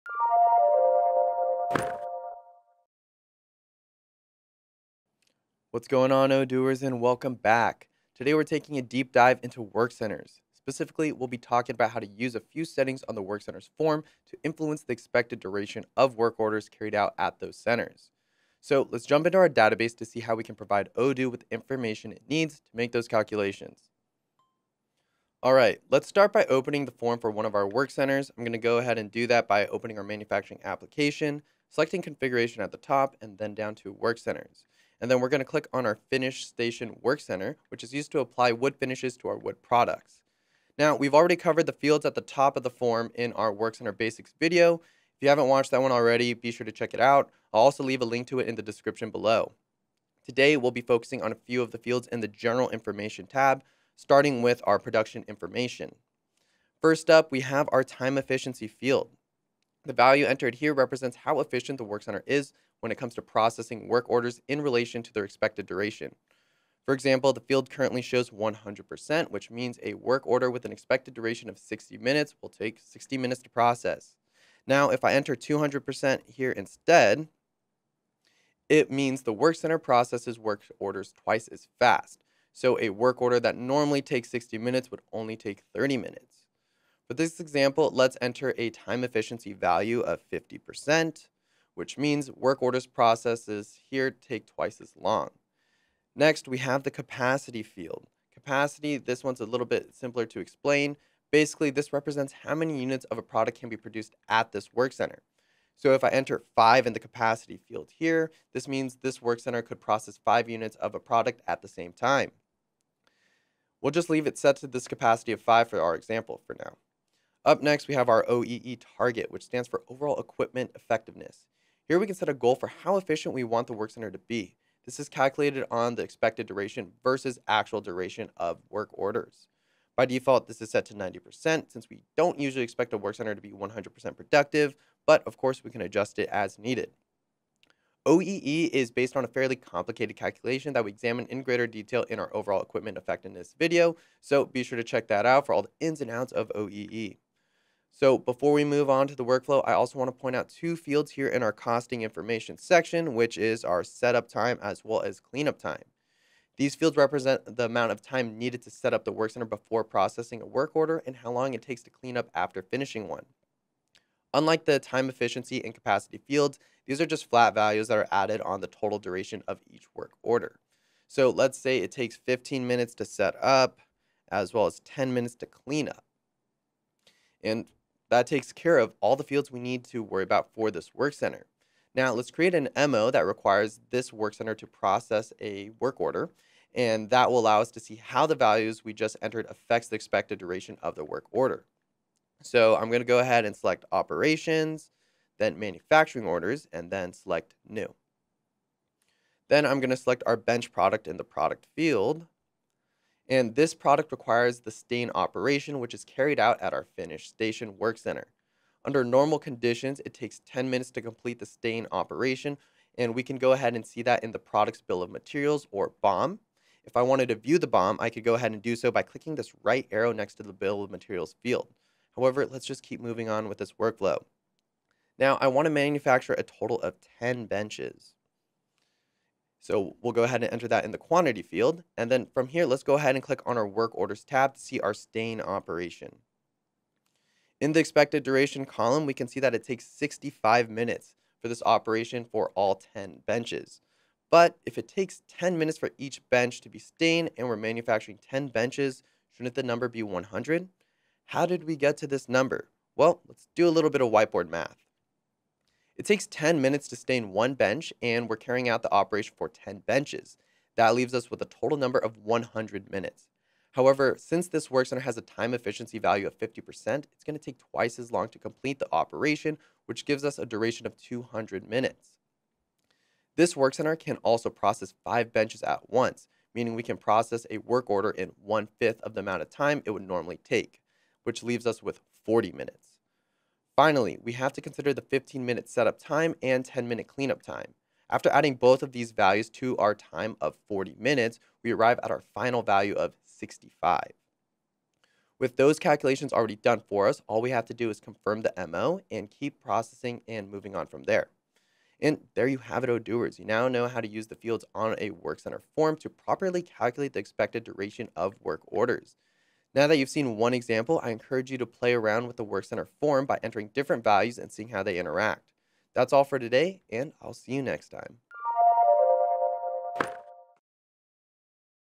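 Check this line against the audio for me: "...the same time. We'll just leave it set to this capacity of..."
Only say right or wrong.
right.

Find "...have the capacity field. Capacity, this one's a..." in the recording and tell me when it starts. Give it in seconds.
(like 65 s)
96 s.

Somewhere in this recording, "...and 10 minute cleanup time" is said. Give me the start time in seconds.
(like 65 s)
286 s.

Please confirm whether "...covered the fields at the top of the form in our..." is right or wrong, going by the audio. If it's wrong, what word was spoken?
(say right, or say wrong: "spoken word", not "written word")
right.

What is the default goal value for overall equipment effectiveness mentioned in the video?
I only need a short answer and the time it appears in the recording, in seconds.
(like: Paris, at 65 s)
90%, at 130 s.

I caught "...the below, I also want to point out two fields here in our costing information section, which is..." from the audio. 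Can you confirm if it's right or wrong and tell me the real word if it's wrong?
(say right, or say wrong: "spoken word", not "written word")
wrong: "workflow", not "below".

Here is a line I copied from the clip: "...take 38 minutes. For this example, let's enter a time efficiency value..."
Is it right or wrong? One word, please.
wrong.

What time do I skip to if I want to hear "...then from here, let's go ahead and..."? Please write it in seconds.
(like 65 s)
232 s.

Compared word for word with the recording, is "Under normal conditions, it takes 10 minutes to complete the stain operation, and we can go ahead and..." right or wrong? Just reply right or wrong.
right.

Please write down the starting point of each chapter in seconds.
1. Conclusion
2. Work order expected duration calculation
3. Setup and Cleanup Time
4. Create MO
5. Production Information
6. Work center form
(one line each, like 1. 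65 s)
1. 301 s
2. 237 s
3. 148 s
4. 181 s
5. 50 s
6. 25 s.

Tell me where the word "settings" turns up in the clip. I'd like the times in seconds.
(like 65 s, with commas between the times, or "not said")
12 s.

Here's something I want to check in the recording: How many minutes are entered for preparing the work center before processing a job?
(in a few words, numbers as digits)
15.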